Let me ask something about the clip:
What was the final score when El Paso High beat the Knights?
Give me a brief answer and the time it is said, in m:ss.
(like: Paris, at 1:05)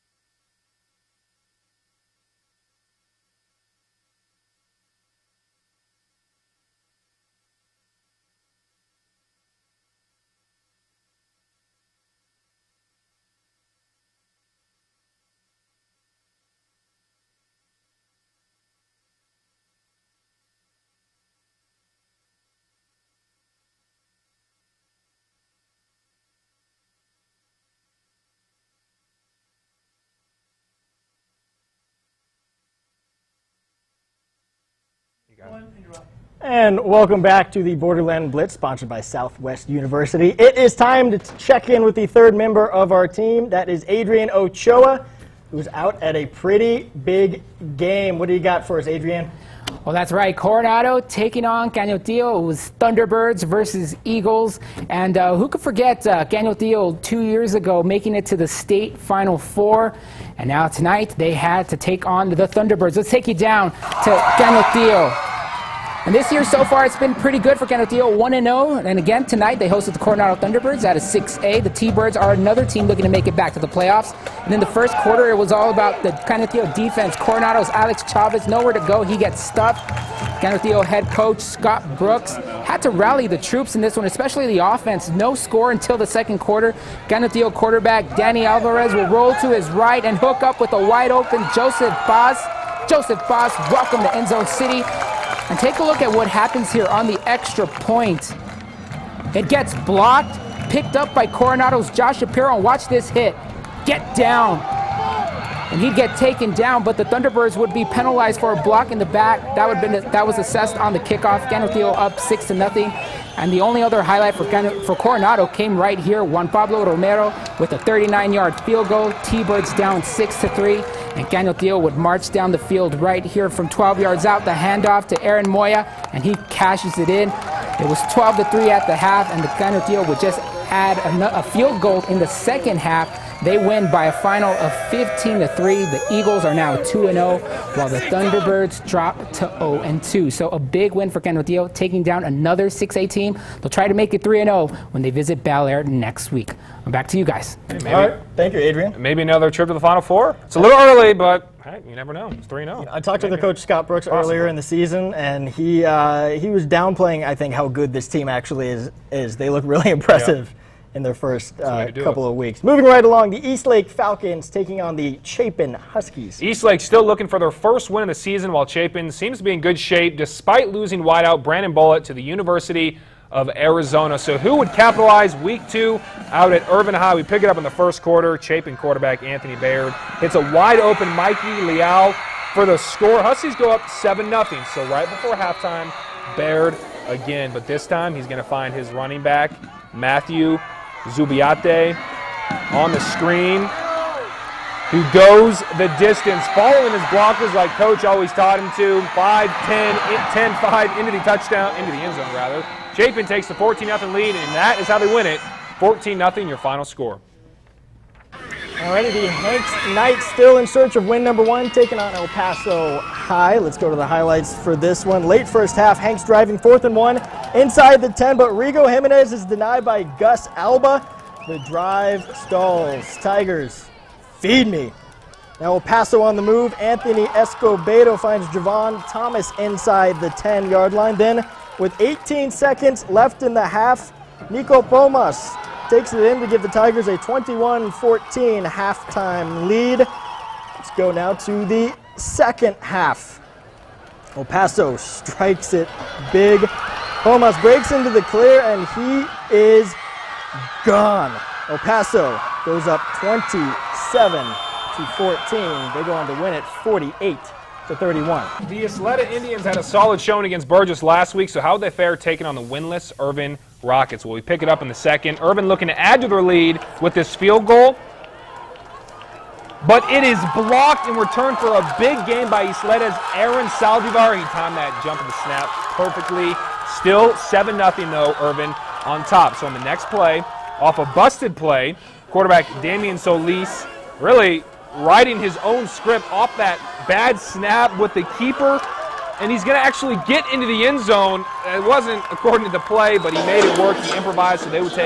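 48 to 31, at 4:16.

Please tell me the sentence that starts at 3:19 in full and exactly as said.
5 10, 10 5 into the touchdown, into the end zone rather.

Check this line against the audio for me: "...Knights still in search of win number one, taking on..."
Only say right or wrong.
right.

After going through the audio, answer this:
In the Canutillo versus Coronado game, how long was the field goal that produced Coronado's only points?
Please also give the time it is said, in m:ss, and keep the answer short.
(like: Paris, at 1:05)
39 yards, at 1:57.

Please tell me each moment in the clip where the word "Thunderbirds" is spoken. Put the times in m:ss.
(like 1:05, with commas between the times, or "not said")
0:52, 1:02, 1:10, 1:47, 2:18.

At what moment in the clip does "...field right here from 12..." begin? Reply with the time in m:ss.
2:02.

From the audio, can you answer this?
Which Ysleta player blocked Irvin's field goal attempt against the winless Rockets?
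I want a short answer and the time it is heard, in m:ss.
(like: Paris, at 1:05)
Aaron Saldivar, at 4:33.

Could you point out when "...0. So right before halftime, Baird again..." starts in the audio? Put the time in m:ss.
3:04.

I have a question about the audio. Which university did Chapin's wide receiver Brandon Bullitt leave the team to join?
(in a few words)
University of Arizona.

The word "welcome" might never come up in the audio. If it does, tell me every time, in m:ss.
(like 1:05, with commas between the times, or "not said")
0:36, 1:33.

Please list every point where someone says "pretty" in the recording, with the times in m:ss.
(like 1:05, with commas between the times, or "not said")
0:46, 1:07.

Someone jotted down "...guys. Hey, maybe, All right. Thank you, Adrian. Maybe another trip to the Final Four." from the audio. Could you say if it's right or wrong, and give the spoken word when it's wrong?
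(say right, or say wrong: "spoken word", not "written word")
right.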